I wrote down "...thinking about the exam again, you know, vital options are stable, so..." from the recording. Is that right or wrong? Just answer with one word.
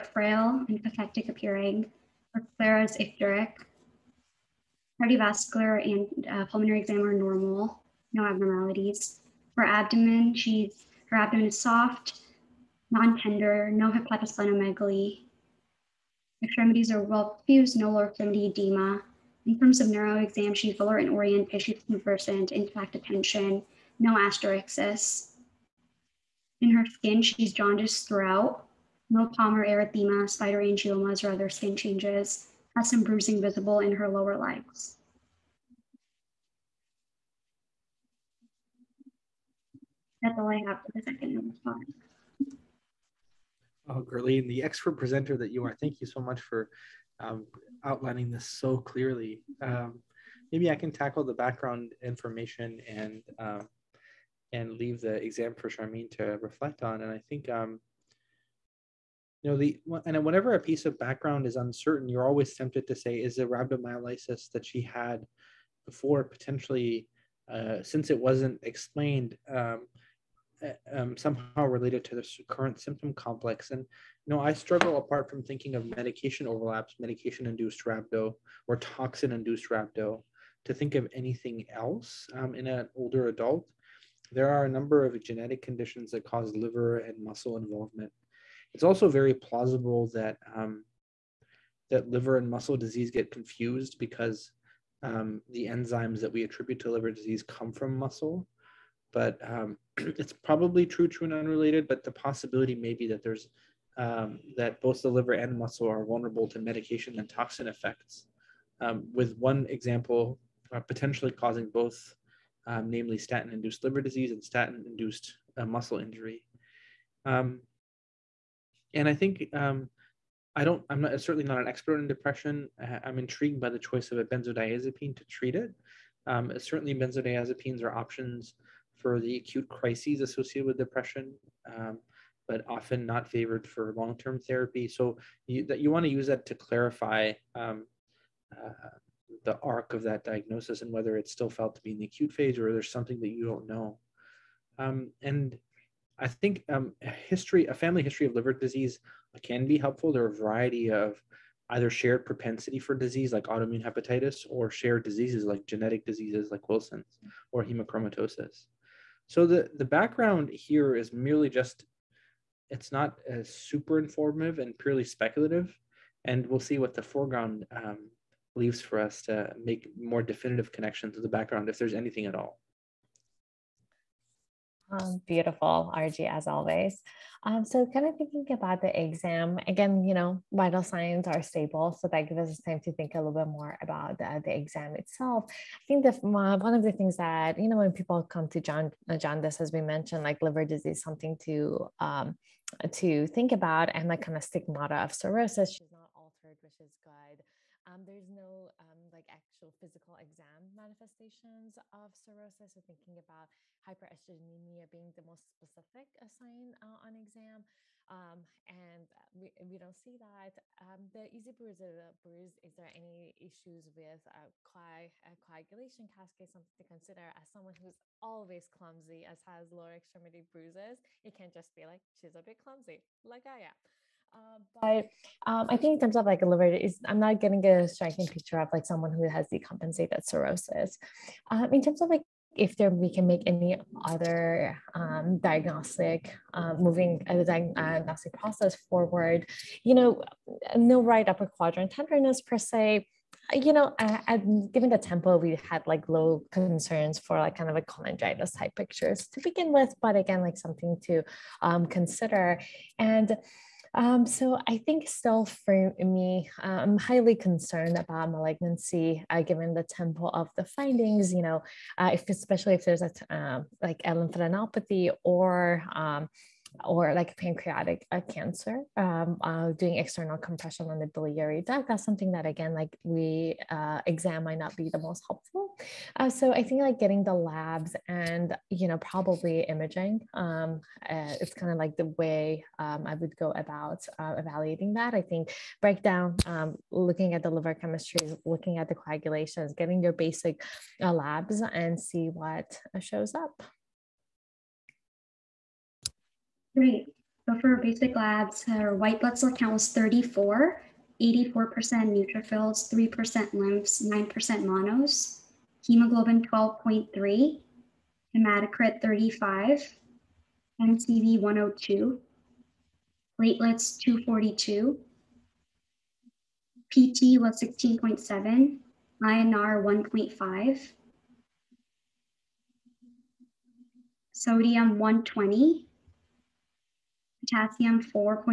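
wrong.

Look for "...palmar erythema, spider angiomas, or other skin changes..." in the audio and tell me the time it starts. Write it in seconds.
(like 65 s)
29 s.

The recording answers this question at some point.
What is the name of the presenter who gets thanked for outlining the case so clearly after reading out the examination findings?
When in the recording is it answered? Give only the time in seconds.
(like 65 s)
44 s.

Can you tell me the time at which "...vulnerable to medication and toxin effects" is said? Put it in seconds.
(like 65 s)
106 s.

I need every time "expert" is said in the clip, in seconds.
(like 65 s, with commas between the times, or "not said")
44 s, 121 s.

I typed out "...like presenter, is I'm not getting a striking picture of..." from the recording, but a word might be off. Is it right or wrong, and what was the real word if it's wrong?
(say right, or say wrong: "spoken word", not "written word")
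wrong: "liver", not "presenter".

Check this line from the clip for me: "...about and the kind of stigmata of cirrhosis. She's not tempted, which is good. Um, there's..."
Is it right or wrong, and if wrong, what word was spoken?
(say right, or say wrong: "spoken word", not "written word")
wrong: "altered", not "tempted".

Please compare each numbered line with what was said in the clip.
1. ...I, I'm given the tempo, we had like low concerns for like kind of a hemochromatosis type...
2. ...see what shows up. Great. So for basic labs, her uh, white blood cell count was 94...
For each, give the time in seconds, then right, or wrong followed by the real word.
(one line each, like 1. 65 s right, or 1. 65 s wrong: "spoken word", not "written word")
1. 243 s wrong: "cholangitis", not "hemochromatosis"
2. 291 s wrong: "34", not "94".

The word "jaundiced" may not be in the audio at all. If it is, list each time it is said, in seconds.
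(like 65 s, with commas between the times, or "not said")
27 s.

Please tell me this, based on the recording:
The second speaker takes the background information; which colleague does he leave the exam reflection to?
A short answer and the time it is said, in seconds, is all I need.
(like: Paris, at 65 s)
Charmaine, at 55 s.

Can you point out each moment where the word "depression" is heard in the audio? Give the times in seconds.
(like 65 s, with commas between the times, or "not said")
122 s, 130 s.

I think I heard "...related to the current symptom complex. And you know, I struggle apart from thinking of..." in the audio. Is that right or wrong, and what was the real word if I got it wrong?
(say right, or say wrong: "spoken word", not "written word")
right.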